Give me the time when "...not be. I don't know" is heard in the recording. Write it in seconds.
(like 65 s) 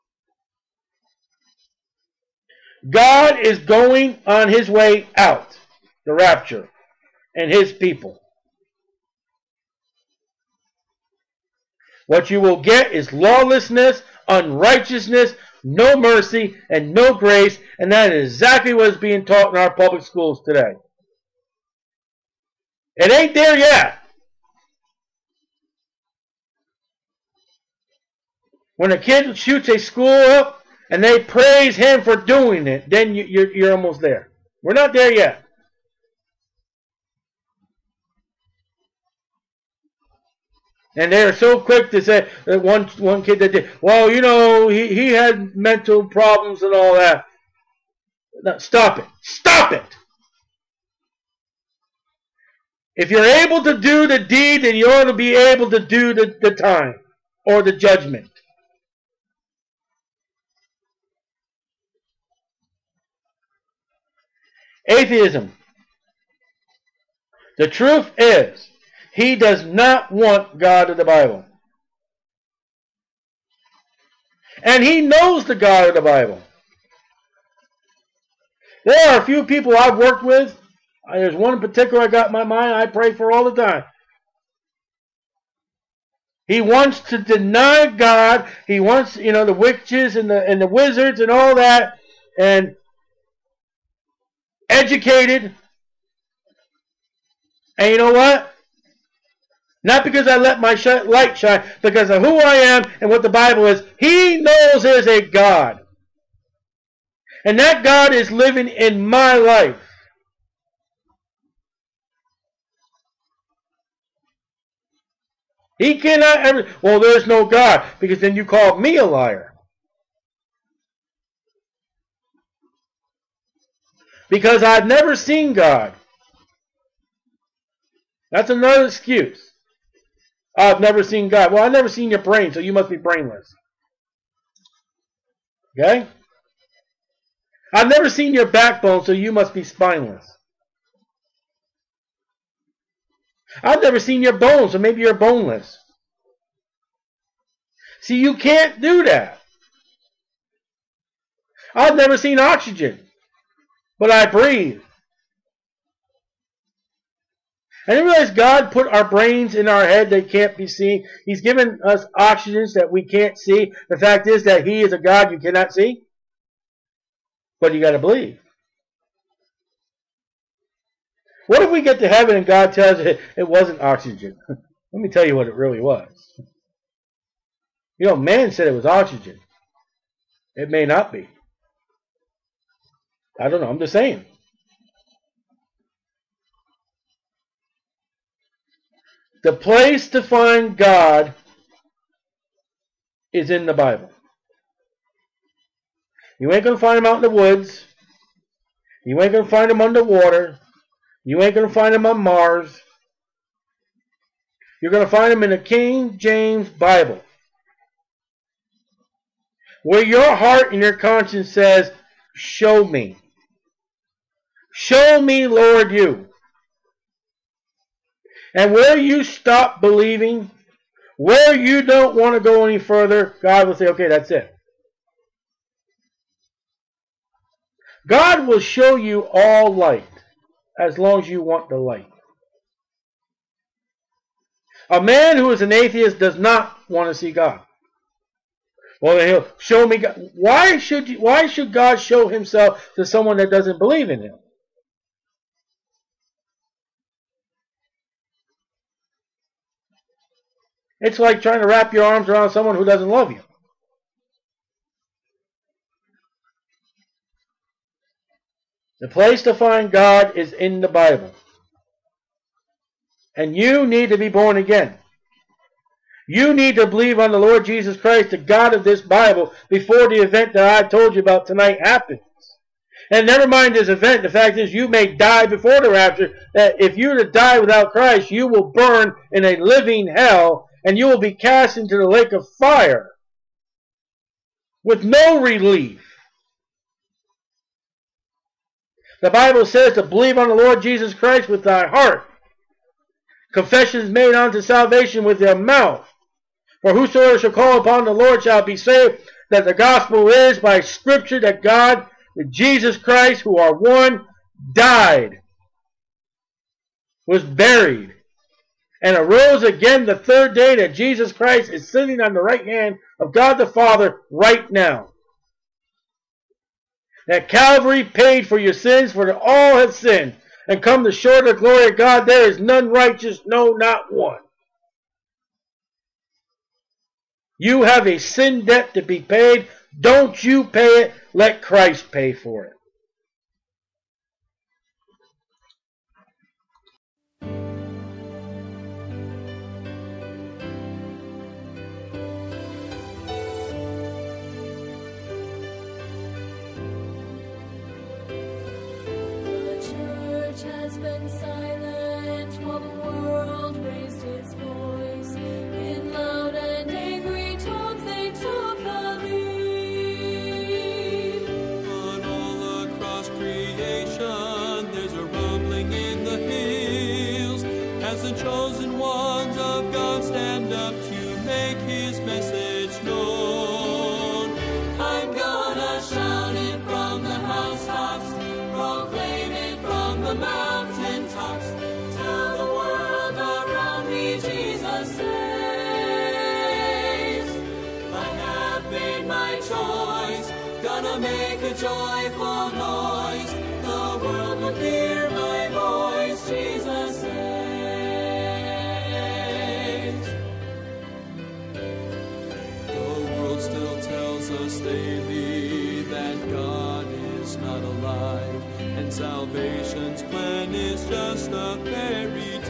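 180 s.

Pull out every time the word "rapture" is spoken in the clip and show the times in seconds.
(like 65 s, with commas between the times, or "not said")
6 s, 275 s.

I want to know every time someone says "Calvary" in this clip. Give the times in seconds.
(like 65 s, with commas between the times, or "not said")
317 s.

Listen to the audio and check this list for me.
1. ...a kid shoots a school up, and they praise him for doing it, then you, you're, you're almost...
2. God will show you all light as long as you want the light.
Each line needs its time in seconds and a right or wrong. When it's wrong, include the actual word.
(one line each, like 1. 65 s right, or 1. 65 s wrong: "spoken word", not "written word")
1. 28 s right
2. 228 s right.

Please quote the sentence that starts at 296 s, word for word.
For whosoever shall call upon the Lord shall be saved.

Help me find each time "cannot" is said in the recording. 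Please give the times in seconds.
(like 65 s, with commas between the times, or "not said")
115 s, 165 s.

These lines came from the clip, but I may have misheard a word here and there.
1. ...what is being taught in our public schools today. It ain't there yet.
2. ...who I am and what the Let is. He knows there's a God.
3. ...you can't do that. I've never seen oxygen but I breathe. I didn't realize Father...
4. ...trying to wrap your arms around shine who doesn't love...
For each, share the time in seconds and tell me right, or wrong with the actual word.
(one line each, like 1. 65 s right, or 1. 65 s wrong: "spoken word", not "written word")
1. 18 s right
2. 102 s wrong: "Bible", not "Let"
3. 148 s wrong: "God", not "Father"
4. 251 s wrong: "someone", not "shine".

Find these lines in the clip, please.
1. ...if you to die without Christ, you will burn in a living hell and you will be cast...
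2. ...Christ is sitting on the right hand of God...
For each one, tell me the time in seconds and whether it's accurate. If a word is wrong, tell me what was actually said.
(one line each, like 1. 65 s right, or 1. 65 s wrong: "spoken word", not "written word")
1. 276 s right
2. 311 s right.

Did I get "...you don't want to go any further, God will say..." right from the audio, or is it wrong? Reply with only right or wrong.
right.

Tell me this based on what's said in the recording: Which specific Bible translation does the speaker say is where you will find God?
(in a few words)
King James Bible.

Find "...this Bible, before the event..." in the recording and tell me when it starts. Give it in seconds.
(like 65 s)
268 s.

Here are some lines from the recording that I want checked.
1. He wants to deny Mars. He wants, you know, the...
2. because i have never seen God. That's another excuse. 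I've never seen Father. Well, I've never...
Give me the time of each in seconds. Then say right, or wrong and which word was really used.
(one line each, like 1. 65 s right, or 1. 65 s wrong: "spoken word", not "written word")
1. 86 s wrong: "God", not "Mars"
2. 124 s wrong: "God", not "Father".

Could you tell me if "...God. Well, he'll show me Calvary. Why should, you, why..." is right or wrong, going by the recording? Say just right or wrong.
wrong.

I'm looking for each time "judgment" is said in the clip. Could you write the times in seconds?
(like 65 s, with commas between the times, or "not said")
57 s.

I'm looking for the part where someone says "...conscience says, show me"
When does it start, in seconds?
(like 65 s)
210 s.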